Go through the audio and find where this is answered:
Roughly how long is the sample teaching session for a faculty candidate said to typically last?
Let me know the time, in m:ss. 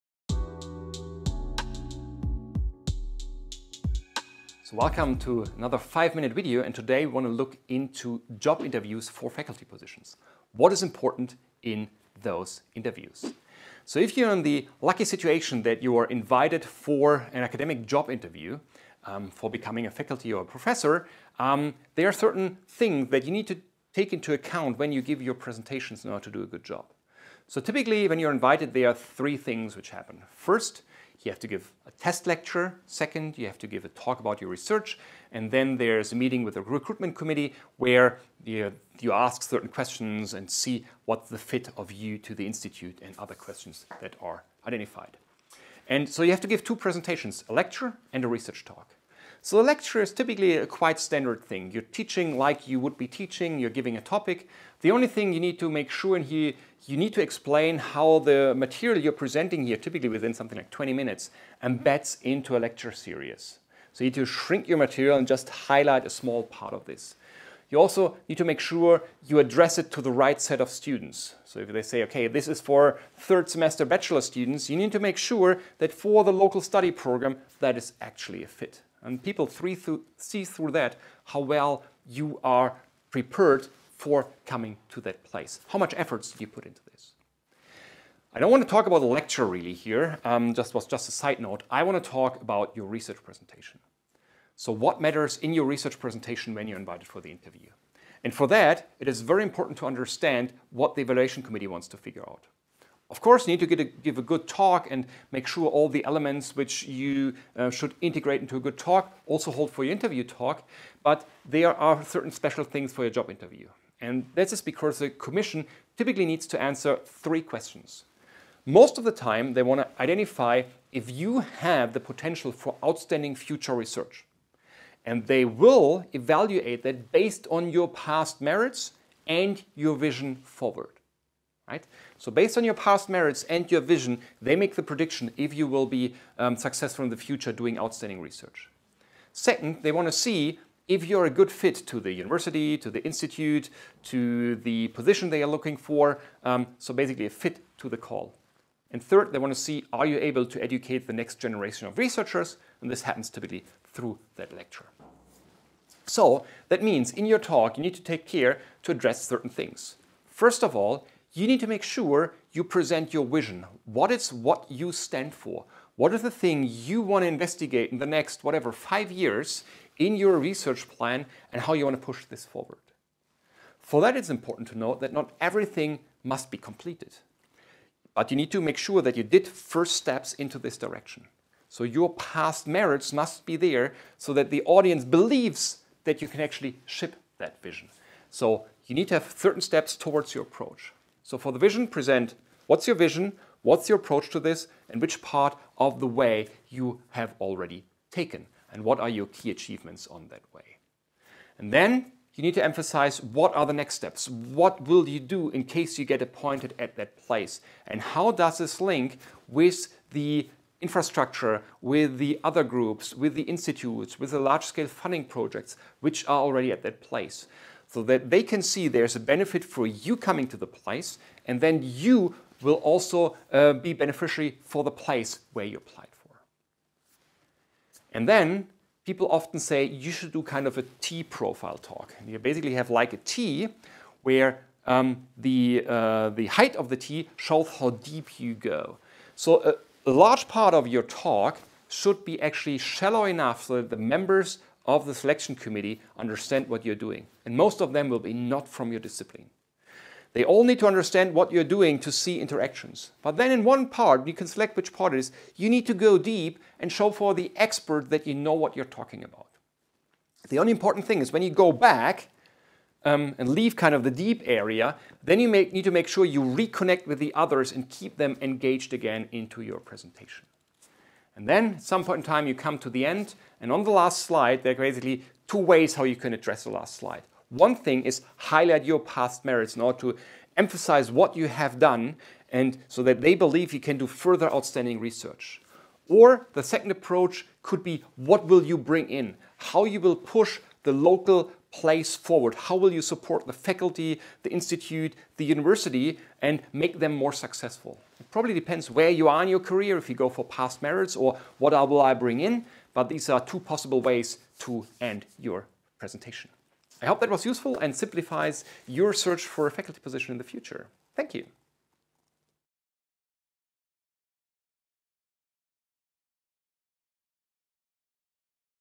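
1:00.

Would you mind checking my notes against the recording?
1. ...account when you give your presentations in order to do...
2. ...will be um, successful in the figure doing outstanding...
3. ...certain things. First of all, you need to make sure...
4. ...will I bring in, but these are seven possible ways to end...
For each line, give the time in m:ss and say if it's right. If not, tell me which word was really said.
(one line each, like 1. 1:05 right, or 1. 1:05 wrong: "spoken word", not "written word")
1. 0:24 right
2. 2:15 wrong: "future", not "figure"
3. 2:39 right
4. 5:01 wrong: "two", not "seven".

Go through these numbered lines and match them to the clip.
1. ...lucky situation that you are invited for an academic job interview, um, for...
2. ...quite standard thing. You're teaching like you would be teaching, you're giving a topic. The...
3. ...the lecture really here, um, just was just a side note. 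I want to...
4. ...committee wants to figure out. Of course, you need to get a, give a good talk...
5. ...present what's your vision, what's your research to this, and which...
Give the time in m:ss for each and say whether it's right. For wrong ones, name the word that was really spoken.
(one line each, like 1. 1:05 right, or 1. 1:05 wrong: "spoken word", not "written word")
1. 0:14 right
2. 0:50 right
3. 1:28 right
4. 1:41 right
5. 3:11 wrong: "approach", not "research".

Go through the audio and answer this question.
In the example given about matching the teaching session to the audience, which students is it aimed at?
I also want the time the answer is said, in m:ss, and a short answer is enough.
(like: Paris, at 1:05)
third semester bachelor students, at 1:13.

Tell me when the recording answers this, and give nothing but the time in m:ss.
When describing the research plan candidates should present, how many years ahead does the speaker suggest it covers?
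2:48.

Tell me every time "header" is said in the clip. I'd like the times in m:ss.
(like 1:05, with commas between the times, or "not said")
not said.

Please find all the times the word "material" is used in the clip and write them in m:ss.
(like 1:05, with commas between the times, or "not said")
0:58, 1:04.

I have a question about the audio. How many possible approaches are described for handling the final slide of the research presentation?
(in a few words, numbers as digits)
2.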